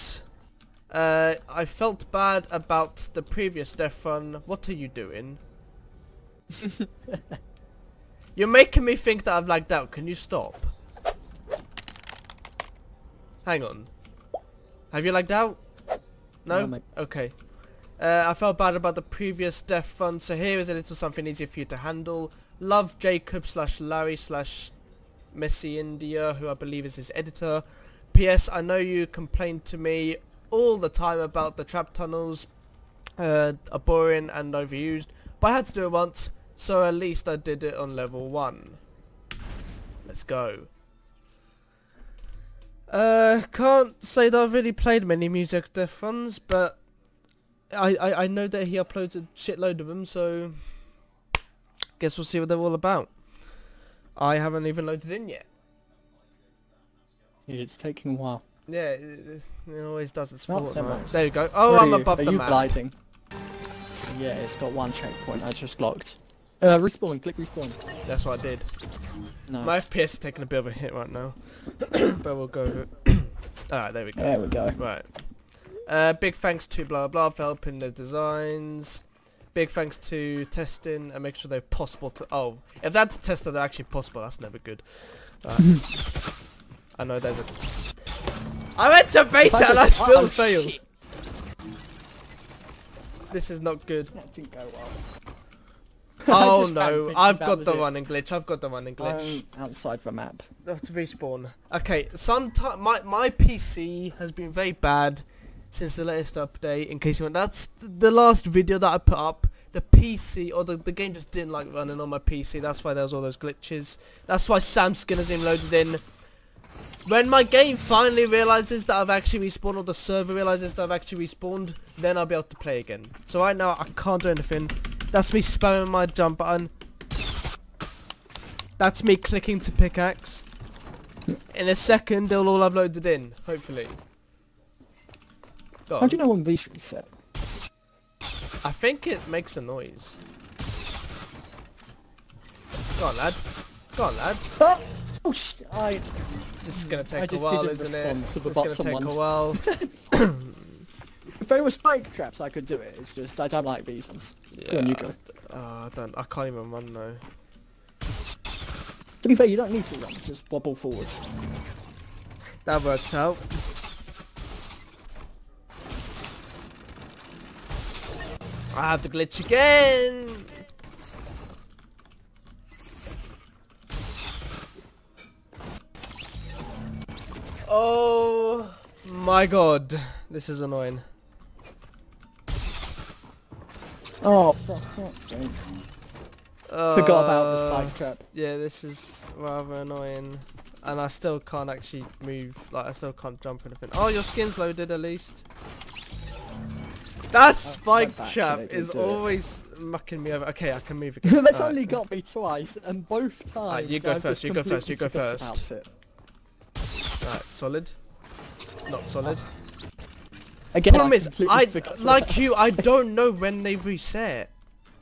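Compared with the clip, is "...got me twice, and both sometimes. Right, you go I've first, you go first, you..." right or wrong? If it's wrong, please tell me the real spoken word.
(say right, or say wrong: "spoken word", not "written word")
wrong: "times", not "sometimes".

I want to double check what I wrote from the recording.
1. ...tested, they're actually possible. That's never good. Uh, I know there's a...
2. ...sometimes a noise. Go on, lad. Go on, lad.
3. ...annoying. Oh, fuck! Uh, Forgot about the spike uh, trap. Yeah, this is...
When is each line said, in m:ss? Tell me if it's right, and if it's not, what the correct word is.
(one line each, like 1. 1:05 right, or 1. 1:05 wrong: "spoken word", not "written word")
1. 1:23 right
2. 2:19 wrong: "makes", not "sometimes"
3. 3:00 right.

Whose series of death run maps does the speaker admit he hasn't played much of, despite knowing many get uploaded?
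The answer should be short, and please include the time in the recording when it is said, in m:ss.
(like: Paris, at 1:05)
Muselk, at 0:45.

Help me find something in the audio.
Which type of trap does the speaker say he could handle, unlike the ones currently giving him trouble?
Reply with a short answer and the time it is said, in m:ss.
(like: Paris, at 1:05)
Spike traps, at 2:31.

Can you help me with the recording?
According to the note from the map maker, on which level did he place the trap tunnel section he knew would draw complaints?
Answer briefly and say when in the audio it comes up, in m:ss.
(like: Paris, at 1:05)
Level 1, at 0:37.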